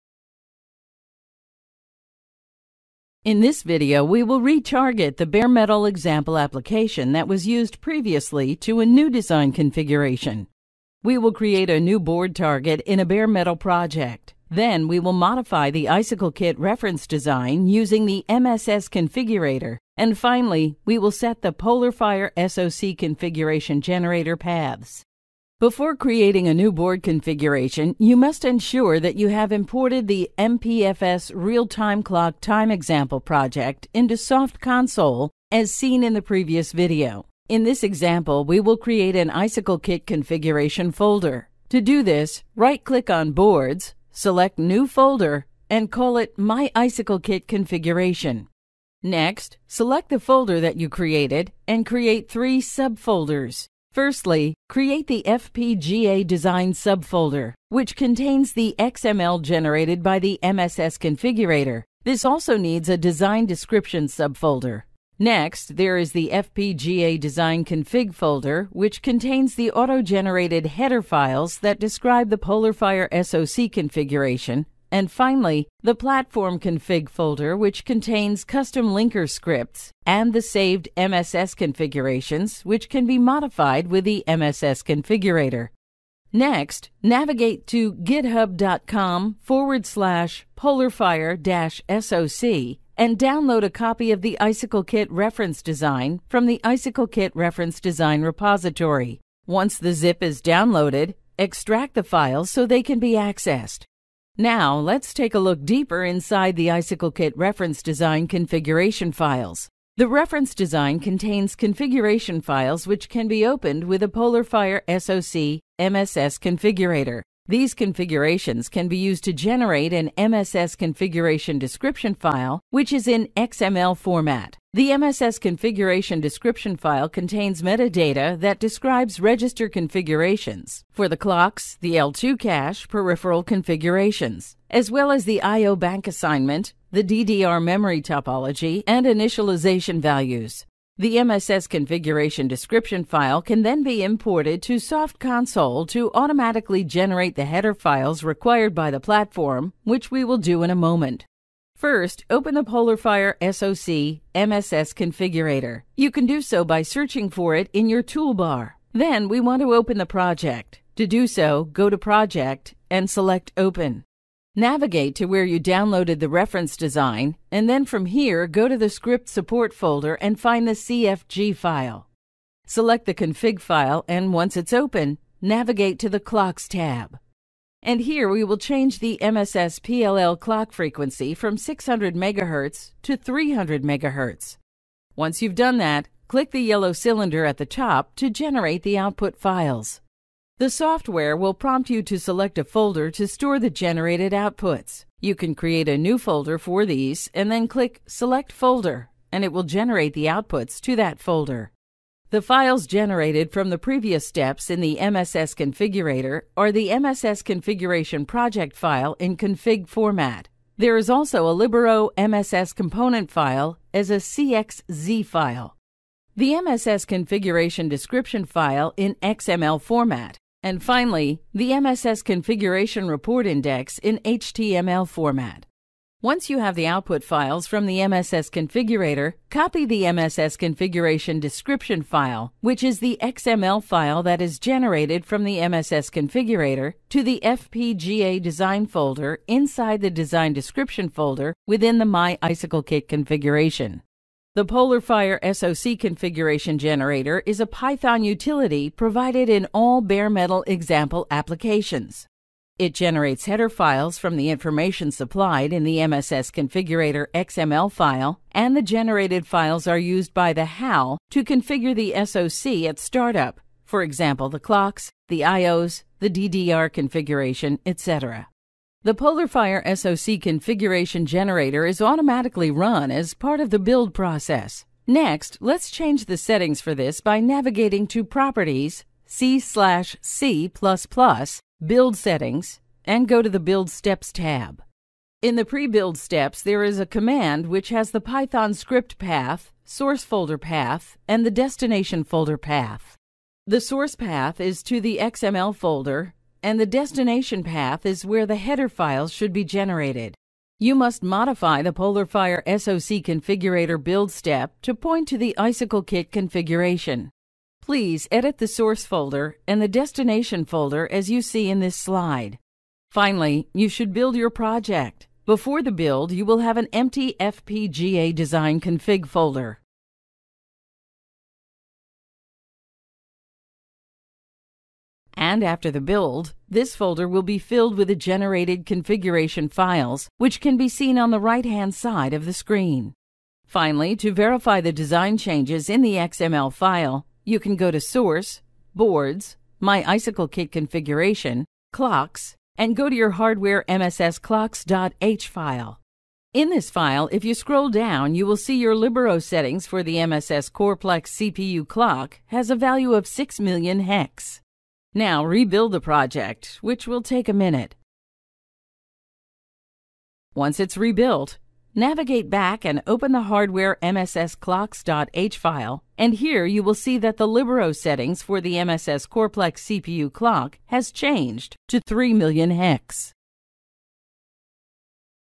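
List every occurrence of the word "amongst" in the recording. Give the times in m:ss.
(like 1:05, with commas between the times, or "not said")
not said.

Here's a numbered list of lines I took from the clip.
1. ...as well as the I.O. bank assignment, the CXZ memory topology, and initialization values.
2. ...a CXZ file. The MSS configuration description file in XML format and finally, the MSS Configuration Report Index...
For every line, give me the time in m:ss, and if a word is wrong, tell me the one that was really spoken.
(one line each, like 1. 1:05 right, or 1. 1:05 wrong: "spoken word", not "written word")
1. 2:14 wrong: "DDR", not "CXZ"
2. 3:34 right.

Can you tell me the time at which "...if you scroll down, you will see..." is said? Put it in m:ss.
5:47.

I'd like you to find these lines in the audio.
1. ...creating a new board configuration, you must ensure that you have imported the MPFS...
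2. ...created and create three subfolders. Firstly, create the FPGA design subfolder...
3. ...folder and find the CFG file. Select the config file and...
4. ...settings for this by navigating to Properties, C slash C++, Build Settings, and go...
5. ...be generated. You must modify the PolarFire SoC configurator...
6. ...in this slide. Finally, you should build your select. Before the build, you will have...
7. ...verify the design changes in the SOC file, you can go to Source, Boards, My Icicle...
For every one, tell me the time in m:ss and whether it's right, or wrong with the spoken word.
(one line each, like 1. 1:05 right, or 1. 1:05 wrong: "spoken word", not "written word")
1. 0:25 right
2. 0:50 right
3. 2:49 right
4. 4:36 right
5. 4:59 right
6. 5:11 wrong: "project", not "select"
7. 5:34 wrong: "XML", not "SOC".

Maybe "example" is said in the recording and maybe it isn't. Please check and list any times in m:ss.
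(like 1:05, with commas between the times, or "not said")
0:05, 0:32, 0:37, 4:10, 4:24.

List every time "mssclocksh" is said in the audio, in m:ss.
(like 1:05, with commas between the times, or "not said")
5:43, 6:04.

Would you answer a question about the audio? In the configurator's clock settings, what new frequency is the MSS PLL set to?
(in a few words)
300 MHz.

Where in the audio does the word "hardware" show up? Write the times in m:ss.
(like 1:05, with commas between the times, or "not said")
5:43, 6:03.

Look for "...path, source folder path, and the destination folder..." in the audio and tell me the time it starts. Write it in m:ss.
4:49.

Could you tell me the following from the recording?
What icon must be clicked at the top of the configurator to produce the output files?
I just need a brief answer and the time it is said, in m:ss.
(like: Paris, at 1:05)
yellow cylinder, at 3:06.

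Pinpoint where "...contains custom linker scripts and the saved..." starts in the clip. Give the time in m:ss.
1:17.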